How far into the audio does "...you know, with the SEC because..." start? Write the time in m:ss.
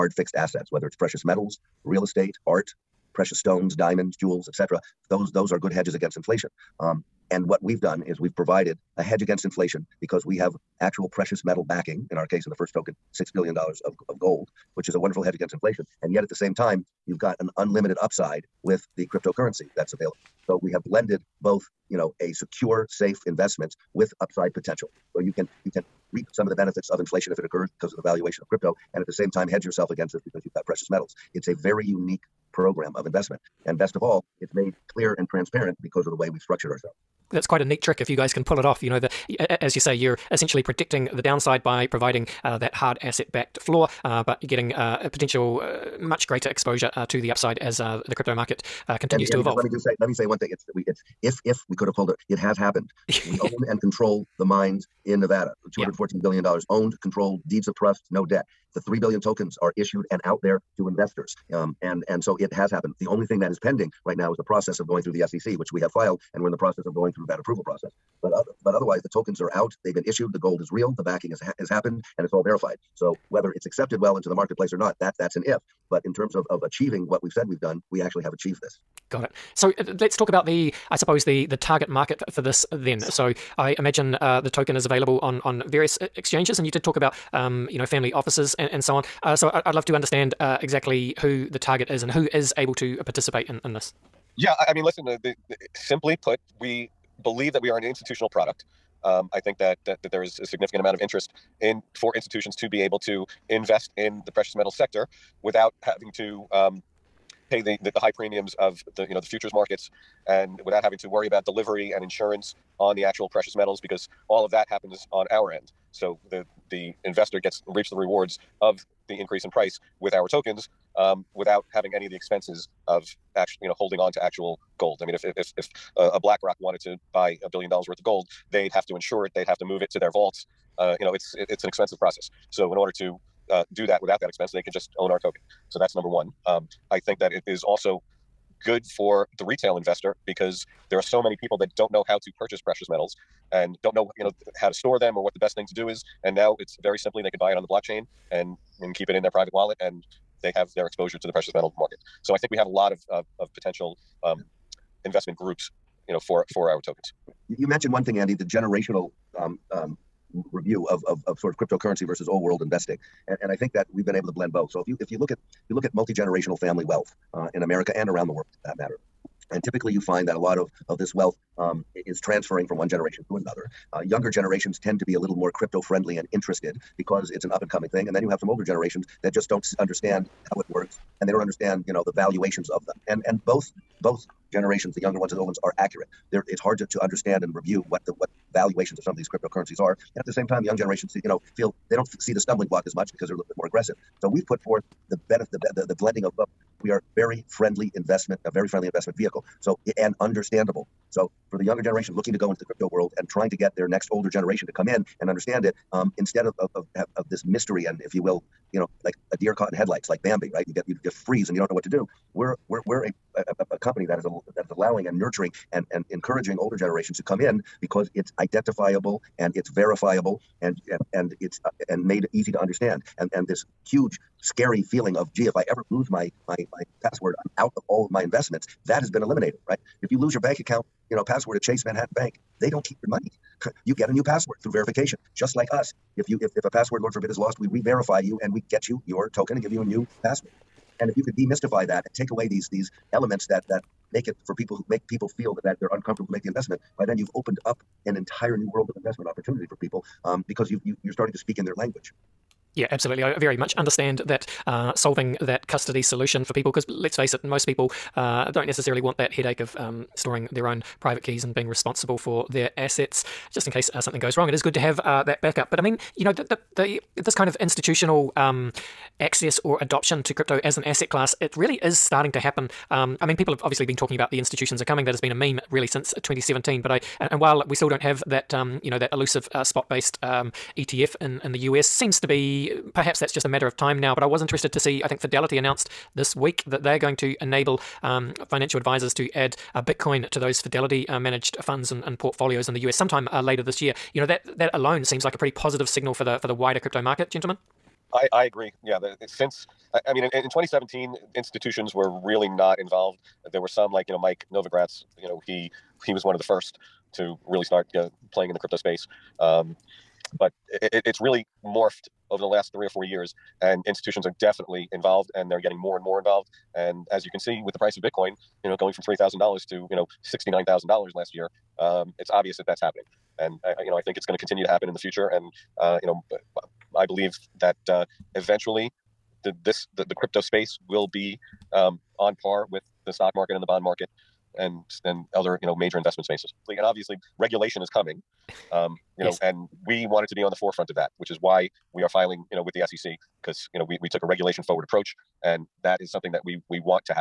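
5:42.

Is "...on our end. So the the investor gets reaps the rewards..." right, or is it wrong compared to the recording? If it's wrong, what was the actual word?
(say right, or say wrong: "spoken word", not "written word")
right.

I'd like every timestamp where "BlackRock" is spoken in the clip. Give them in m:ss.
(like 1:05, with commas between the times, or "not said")
2:06.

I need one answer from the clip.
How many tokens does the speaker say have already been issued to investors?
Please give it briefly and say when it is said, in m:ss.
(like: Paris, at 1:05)
3 billion, at 0:58.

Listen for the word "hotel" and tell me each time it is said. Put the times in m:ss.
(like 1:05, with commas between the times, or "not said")
not said.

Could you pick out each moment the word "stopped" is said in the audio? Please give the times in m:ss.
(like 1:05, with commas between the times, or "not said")
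not said.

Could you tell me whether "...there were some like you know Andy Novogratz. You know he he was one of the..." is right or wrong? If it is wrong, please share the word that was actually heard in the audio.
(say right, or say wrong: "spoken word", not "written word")
wrong: "Mike", not "Andy".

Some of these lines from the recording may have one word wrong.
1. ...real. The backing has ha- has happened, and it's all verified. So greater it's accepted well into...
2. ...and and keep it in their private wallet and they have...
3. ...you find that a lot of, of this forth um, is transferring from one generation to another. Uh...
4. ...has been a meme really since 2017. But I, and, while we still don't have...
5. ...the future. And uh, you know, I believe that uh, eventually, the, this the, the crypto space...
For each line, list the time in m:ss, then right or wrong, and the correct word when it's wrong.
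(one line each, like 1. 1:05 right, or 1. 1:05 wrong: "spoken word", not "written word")
1. 1:10 wrong: "whether", not "greater"
2. 2:28 right
3. 2:49 wrong: "wealth", not "forth"
4. 4:35 right
5. 5:24 right.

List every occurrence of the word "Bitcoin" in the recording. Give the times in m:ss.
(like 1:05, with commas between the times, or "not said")
4:49, 5:18.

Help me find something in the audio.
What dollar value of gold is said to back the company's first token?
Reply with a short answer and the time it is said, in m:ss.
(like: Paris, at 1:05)
$6 billion, at 0:13.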